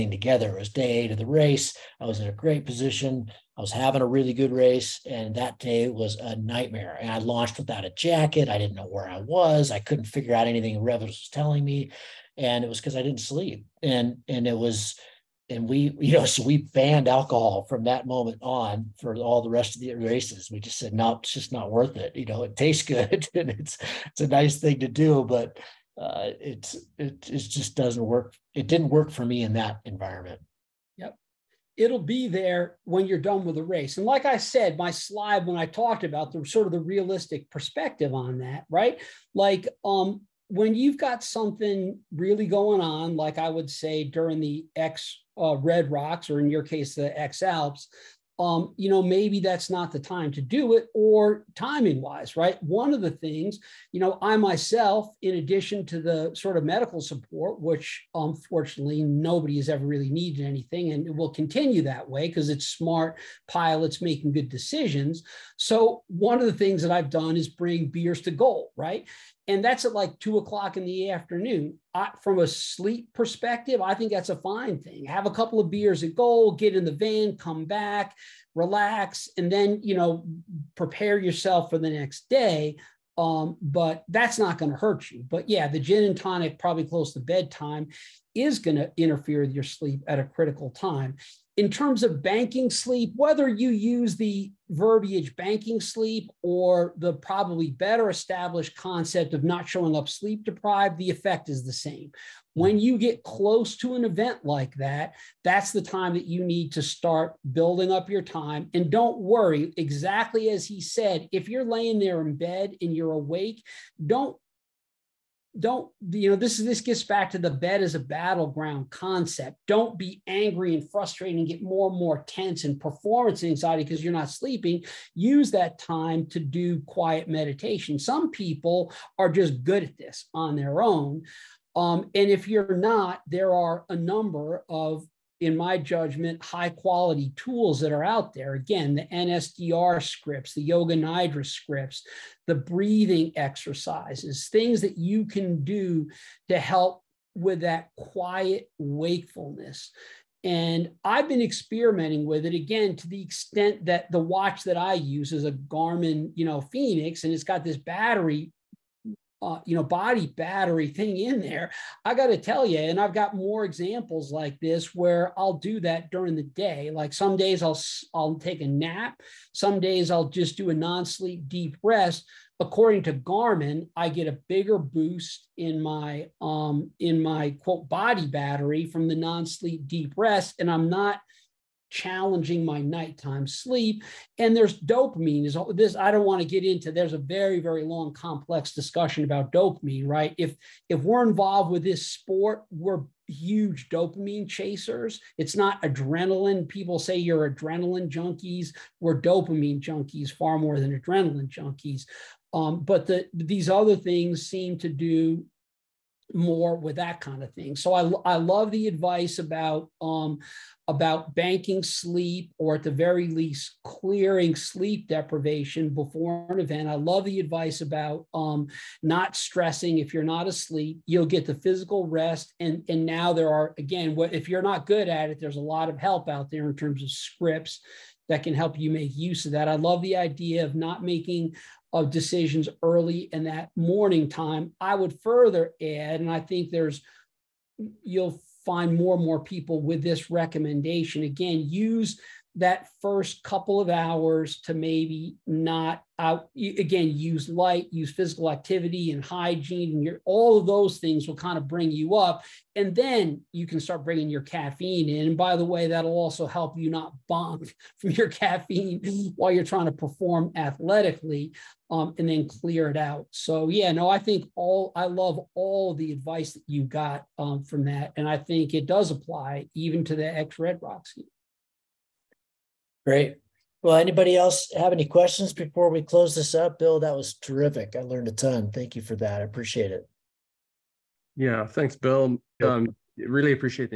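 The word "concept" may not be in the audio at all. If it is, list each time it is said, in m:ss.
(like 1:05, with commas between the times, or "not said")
1:38, 1:58.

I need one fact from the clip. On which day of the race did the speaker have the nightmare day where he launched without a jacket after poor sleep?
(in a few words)
Day 8.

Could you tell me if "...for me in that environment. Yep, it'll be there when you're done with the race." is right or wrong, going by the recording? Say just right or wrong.
right.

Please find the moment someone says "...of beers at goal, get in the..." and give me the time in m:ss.
1:15.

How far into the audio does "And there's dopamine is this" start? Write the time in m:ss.
3:04.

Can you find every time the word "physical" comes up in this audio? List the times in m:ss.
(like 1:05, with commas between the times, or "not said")
3:41, 4:08.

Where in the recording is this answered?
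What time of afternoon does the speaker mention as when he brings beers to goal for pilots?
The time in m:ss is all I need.
1:10.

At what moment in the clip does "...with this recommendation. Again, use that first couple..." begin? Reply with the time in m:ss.
3:59.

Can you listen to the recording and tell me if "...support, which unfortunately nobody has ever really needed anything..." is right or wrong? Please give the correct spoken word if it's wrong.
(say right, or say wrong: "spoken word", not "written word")
right.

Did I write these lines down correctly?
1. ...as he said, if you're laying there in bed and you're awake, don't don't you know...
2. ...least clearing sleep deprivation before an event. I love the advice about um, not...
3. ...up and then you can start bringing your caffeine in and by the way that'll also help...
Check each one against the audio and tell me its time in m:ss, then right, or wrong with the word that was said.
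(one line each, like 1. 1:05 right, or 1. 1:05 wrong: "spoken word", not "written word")
1. 1:50 right
2. 3:33 right
3. 4:12 right.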